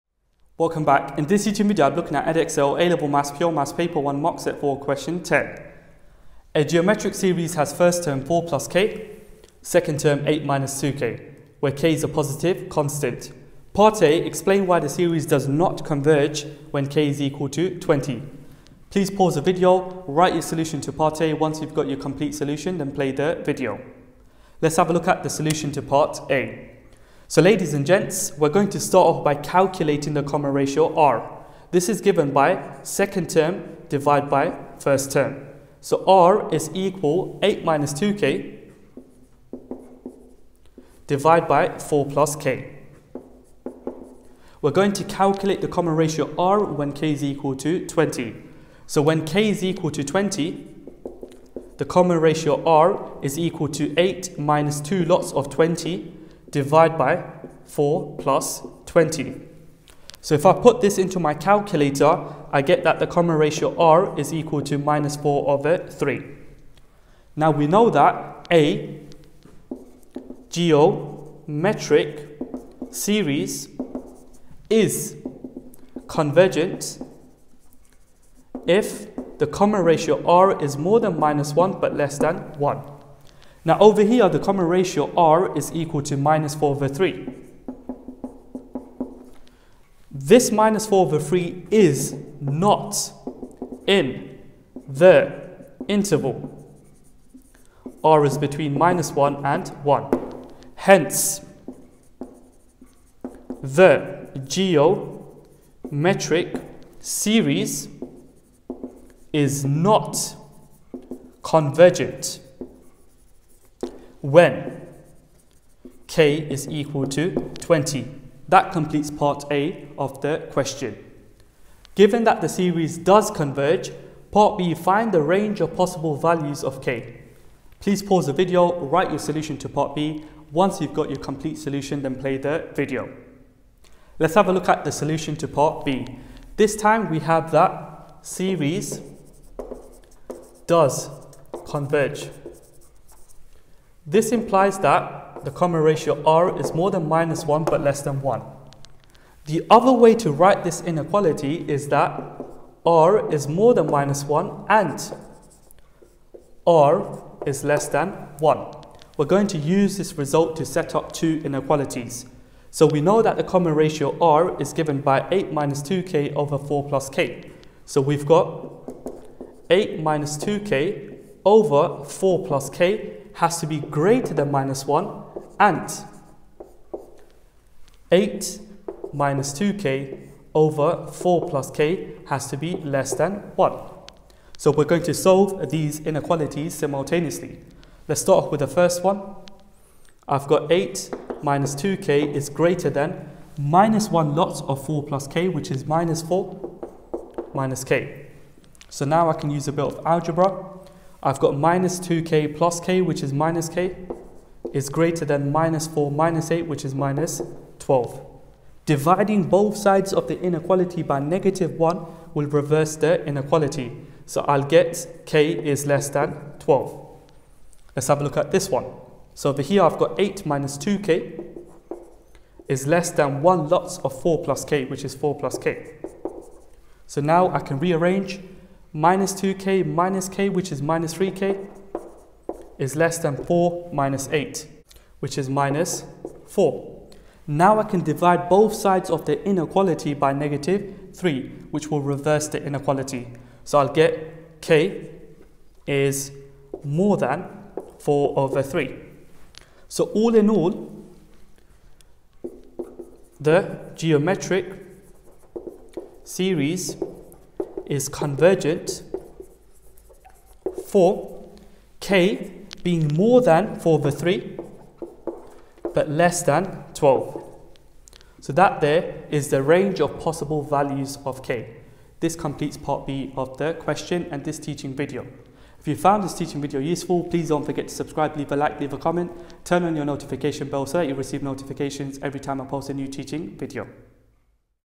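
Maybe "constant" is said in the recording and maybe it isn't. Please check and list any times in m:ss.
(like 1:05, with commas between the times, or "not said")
0:12.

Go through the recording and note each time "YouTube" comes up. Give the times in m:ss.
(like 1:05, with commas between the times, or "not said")
0:01.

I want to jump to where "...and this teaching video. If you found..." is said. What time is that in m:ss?
4:34.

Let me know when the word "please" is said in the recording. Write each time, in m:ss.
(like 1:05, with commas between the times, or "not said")
0:18, 2:07, 4:37.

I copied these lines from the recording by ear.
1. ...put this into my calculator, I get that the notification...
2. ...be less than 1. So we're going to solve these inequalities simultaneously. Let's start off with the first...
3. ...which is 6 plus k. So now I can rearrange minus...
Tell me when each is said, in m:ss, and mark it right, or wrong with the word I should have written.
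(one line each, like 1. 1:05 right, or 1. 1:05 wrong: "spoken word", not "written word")
1. 1:00 wrong: "common", not "notification"
2. 3:02 right
3. 3:44 wrong: "4", not "6".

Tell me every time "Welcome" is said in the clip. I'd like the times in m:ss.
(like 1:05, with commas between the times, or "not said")
0:00.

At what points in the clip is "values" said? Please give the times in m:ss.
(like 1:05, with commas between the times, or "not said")
2:06, 4:30.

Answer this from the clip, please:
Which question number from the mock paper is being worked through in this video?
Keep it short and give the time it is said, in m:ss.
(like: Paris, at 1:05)
10, at 0:04.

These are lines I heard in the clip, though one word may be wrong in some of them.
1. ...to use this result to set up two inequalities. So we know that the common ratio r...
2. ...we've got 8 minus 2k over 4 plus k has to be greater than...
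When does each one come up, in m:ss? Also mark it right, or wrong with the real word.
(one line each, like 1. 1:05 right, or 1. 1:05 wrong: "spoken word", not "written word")
1. 2:39 right
2. 2:48 right.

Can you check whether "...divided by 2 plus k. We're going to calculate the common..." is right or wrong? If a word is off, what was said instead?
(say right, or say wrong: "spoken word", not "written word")
wrong: "4", not "2".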